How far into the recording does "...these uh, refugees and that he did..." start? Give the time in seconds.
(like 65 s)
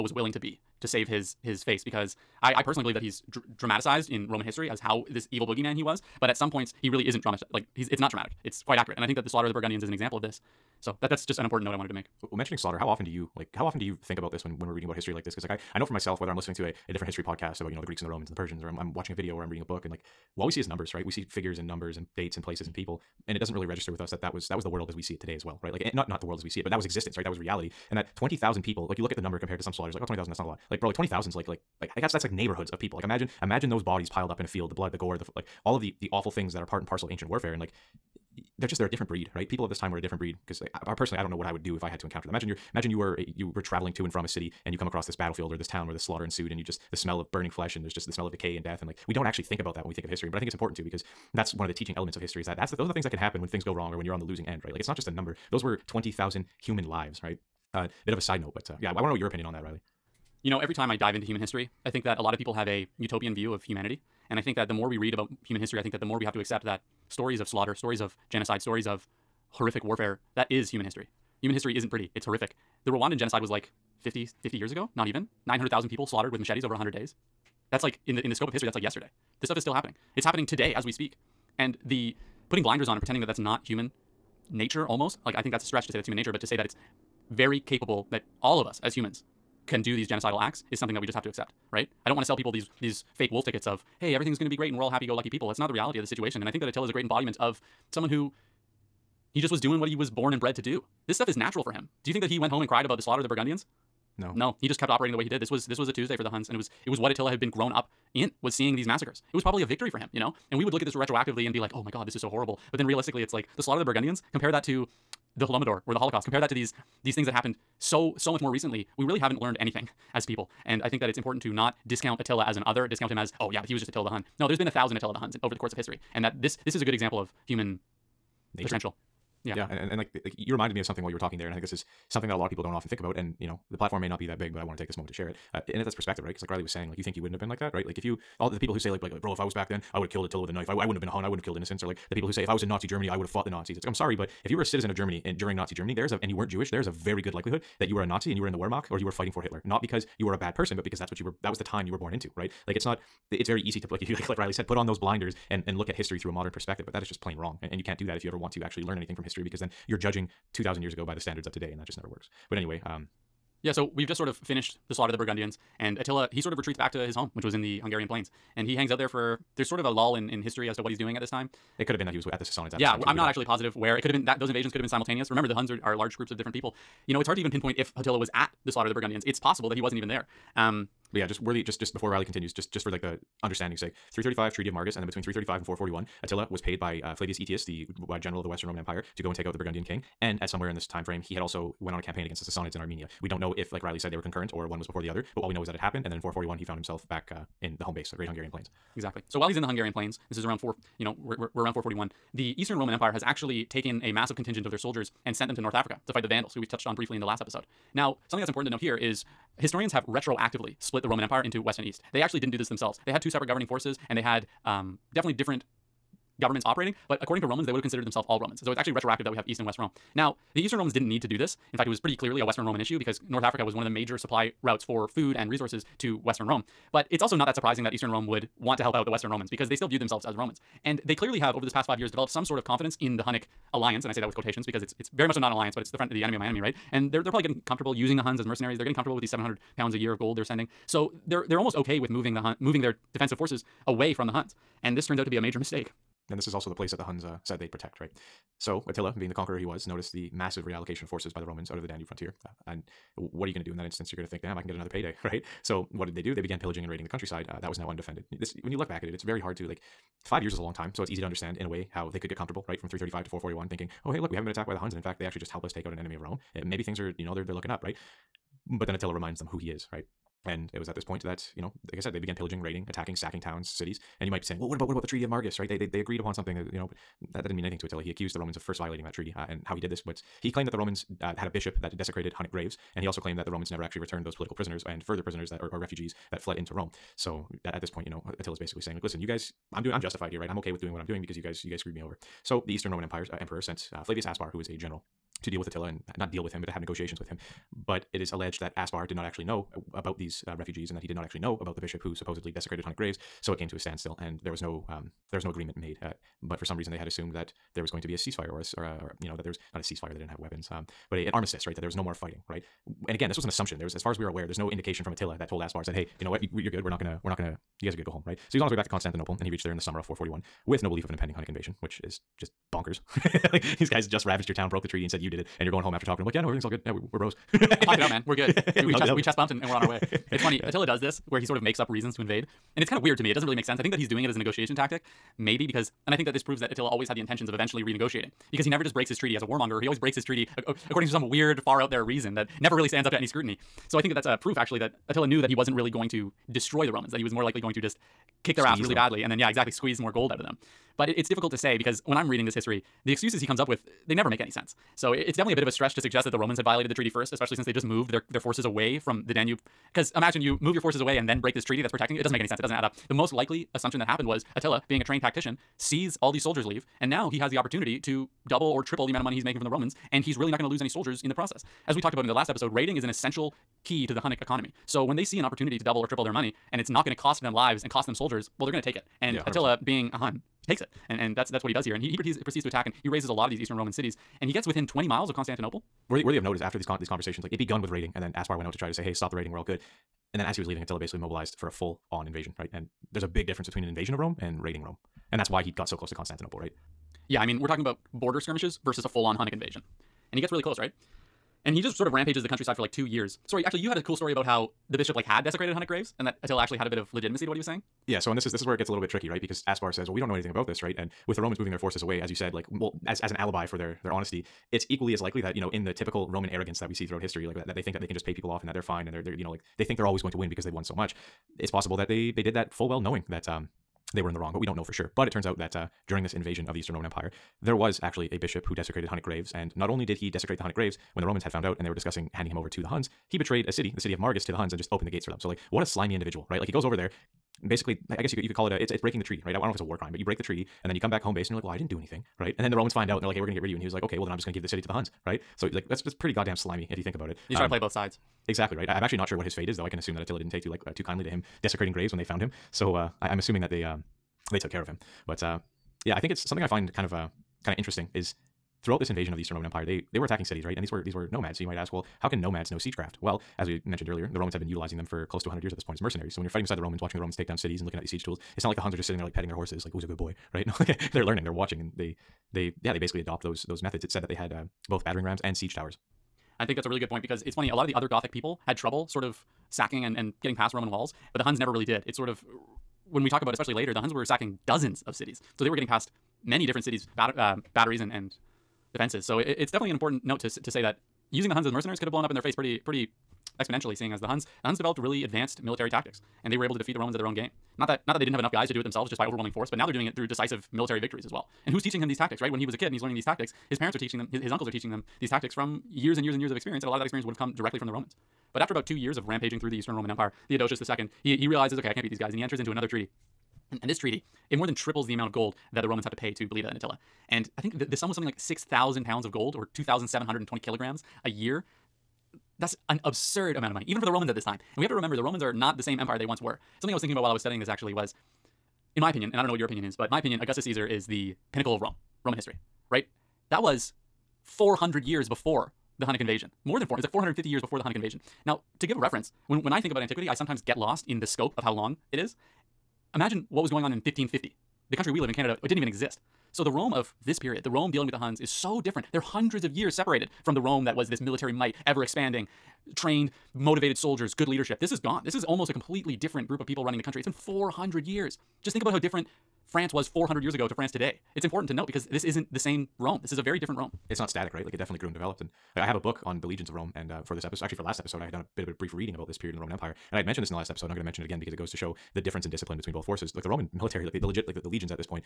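300 s.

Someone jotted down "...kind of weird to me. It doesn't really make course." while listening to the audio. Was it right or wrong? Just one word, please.
wrong.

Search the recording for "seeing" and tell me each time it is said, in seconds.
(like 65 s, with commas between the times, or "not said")
108 s, 493 s.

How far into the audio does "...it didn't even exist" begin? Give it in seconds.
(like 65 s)
545 s.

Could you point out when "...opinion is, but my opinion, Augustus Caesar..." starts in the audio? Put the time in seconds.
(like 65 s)
529 s.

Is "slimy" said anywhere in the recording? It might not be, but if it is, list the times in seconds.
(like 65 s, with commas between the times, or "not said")
435 s, 446 s.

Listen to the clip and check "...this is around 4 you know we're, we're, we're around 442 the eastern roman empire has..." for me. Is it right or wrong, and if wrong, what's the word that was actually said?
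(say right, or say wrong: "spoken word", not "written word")
wrong: "441", not "442".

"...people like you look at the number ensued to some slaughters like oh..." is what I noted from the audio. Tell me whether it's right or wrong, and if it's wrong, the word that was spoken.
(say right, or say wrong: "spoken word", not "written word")
wrong: "compared", not "ensued".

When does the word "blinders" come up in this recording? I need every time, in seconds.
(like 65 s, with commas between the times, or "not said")
82 s, 154 s.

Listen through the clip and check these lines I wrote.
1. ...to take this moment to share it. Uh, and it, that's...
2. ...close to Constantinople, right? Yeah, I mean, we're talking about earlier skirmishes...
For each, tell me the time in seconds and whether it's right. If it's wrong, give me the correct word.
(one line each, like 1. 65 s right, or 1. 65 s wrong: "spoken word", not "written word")
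1. 134 s right
2. 395 s wrong: "border", not "earlier".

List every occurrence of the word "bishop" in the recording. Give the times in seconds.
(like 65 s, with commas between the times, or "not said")
281 s, 301 s, 404 s, 428 s.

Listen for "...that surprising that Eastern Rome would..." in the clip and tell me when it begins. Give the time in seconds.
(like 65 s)
227 s.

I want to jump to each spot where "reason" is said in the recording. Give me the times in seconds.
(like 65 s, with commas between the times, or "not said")
306 s, 331 s, 342 s.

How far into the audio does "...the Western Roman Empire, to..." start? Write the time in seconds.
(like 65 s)
188 s.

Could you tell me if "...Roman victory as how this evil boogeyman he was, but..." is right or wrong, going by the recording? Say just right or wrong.
wrong.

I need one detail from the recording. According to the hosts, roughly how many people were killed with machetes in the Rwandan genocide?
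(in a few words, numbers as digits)
900,000.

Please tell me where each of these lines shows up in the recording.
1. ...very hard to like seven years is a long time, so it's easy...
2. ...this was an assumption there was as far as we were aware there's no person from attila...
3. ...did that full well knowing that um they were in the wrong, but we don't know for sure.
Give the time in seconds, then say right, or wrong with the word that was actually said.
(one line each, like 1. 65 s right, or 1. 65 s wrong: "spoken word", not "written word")
1. 259 s wrong: "five", not "seven"
2. 313 s wrong: "indication", not "person"
3. 422 s right.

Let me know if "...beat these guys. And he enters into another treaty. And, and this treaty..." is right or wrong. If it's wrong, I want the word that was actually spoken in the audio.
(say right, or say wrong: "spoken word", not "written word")
right.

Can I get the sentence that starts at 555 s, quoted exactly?
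This is almost a completely different group of people running the country.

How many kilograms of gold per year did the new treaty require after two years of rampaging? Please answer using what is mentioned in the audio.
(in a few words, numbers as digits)
2,720.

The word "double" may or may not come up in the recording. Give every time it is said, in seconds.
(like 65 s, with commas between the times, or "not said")
368 s, 375 s.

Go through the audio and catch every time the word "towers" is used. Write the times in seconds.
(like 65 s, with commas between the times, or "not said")
475 s.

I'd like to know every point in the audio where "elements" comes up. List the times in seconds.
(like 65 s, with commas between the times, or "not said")
51 s.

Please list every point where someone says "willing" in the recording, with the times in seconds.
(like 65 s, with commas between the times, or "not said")
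0 s.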